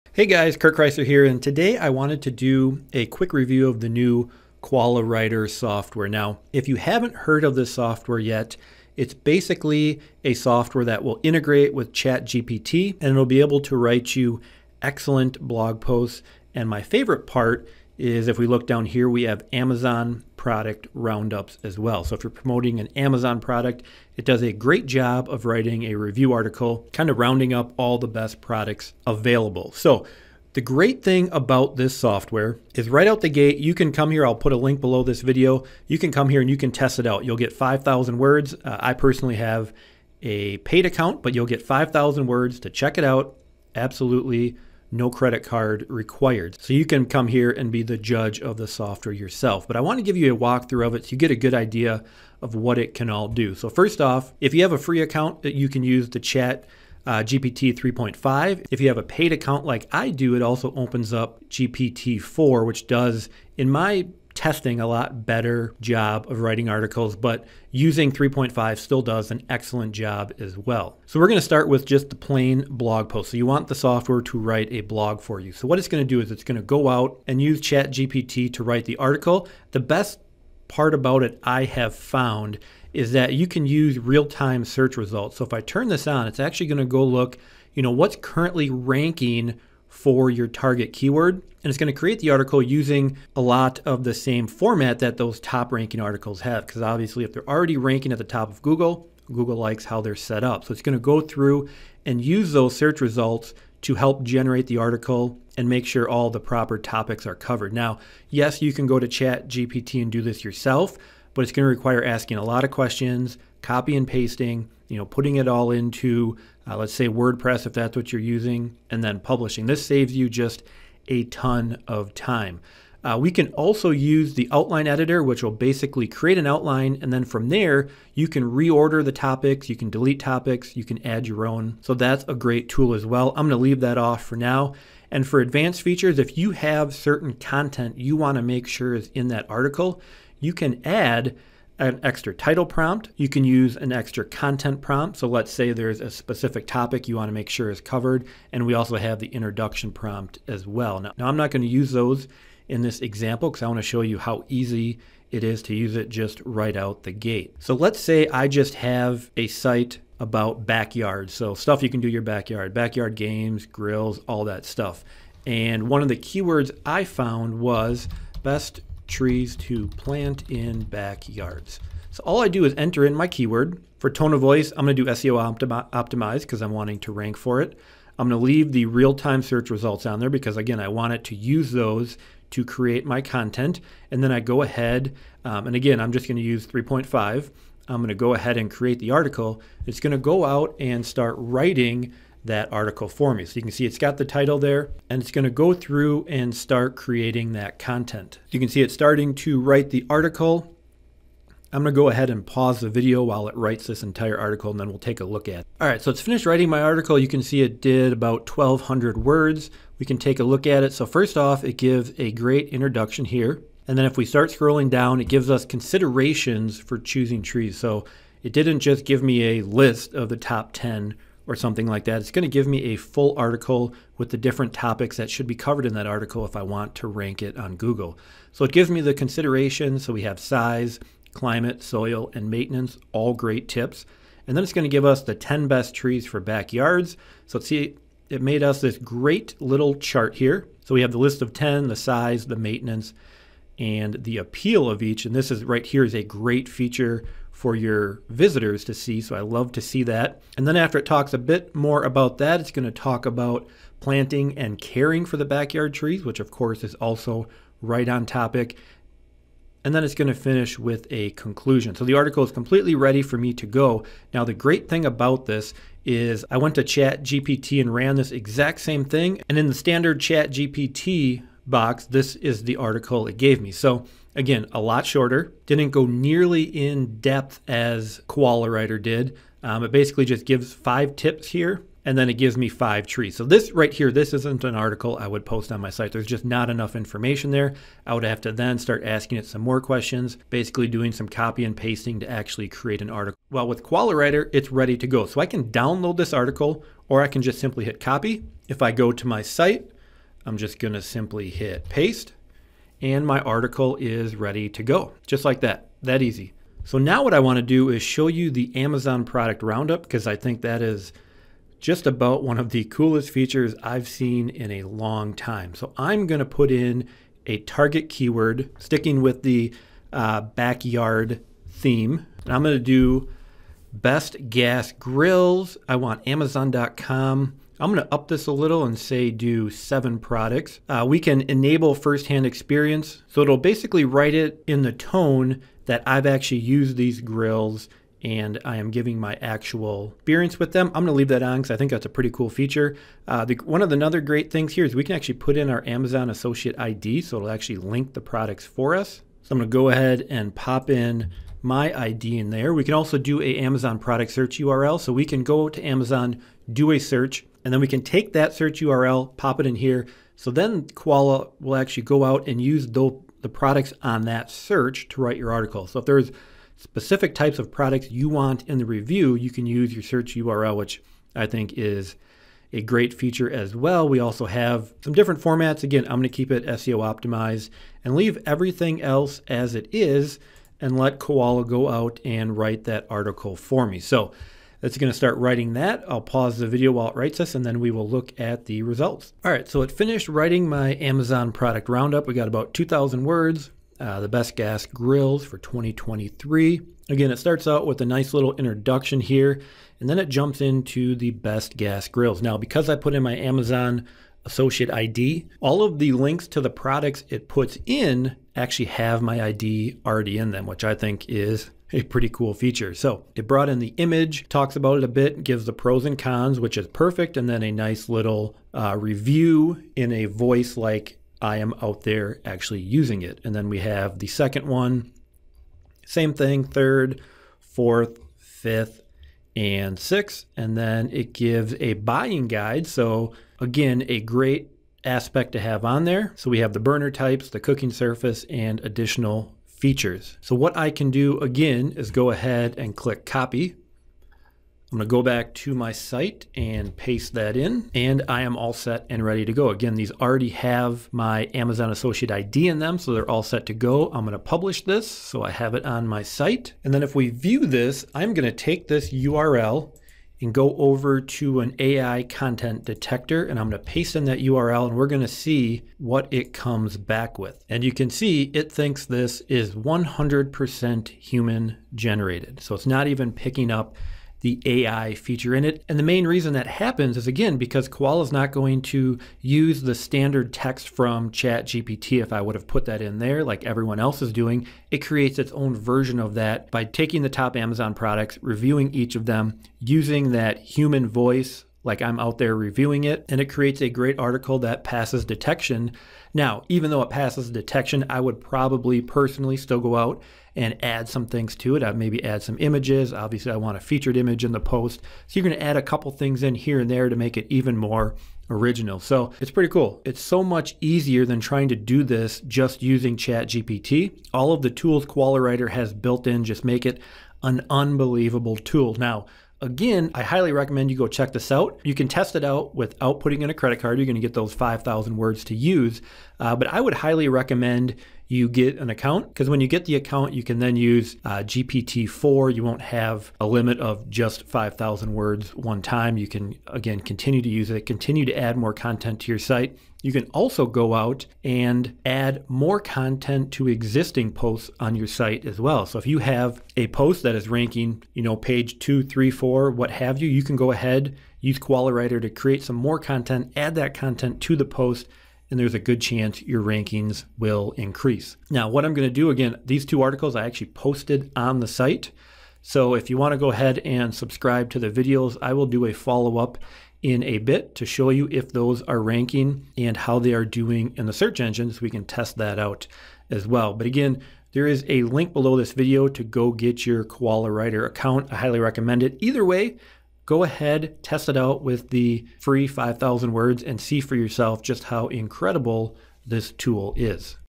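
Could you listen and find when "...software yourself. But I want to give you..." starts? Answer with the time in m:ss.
0:48.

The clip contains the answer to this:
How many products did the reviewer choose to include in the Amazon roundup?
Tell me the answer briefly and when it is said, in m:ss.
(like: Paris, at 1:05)
7, at 5:29.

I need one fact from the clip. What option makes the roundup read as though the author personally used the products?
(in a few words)
firsthand experience.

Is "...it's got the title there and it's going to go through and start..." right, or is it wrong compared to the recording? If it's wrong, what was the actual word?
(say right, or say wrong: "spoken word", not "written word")
right.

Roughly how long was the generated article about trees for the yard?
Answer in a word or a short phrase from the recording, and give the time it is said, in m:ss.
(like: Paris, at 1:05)
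1,200 words, at 3:28.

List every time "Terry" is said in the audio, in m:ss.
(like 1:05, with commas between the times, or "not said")
not said.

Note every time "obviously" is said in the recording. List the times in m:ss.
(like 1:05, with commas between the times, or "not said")
1:36, 8:23.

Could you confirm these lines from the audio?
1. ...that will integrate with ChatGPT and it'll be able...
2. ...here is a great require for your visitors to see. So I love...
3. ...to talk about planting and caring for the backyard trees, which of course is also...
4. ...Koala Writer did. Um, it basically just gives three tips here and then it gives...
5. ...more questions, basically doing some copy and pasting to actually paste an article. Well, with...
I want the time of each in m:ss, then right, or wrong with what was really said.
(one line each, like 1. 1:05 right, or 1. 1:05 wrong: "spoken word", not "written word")
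1. 0:10 right
2. 4:05 wrong: "feature", not "require"
3. 4:12 right
4. 4:38 wrong: "five", not "three"
5. 4:49 wrong: "create", not "paste".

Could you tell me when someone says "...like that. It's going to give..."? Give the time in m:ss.
3:41.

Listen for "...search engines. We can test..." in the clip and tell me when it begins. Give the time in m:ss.
9:31.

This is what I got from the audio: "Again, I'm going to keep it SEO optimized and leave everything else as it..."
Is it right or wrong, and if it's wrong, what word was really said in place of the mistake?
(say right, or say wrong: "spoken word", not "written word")
right.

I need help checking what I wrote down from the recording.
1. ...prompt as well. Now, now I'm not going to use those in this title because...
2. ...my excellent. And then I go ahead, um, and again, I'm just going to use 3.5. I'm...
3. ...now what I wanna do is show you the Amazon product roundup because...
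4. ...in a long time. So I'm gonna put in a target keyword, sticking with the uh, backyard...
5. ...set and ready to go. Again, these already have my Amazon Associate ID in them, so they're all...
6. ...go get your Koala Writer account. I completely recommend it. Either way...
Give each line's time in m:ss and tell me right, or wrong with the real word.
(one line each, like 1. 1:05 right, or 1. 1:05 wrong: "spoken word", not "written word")
1. 2:29 wrong: "example", not "title"
2. 3:03 wrong: "content", not "excellent"
3. 5:06 right
4. 5:14 right
5. 7:28 right
6. 9:36 wrong: "highly", not "completely".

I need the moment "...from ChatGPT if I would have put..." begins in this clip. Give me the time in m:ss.
8:00.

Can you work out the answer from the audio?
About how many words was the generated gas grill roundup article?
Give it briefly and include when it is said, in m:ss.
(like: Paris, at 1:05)
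2,000, at 6:32.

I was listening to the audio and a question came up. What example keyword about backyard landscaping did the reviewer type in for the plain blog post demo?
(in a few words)
best trees to plant in backyards.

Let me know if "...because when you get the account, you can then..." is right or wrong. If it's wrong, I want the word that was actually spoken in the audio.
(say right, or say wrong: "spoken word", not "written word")
right.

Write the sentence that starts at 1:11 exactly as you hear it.
So we're going to start with just the plain blog post.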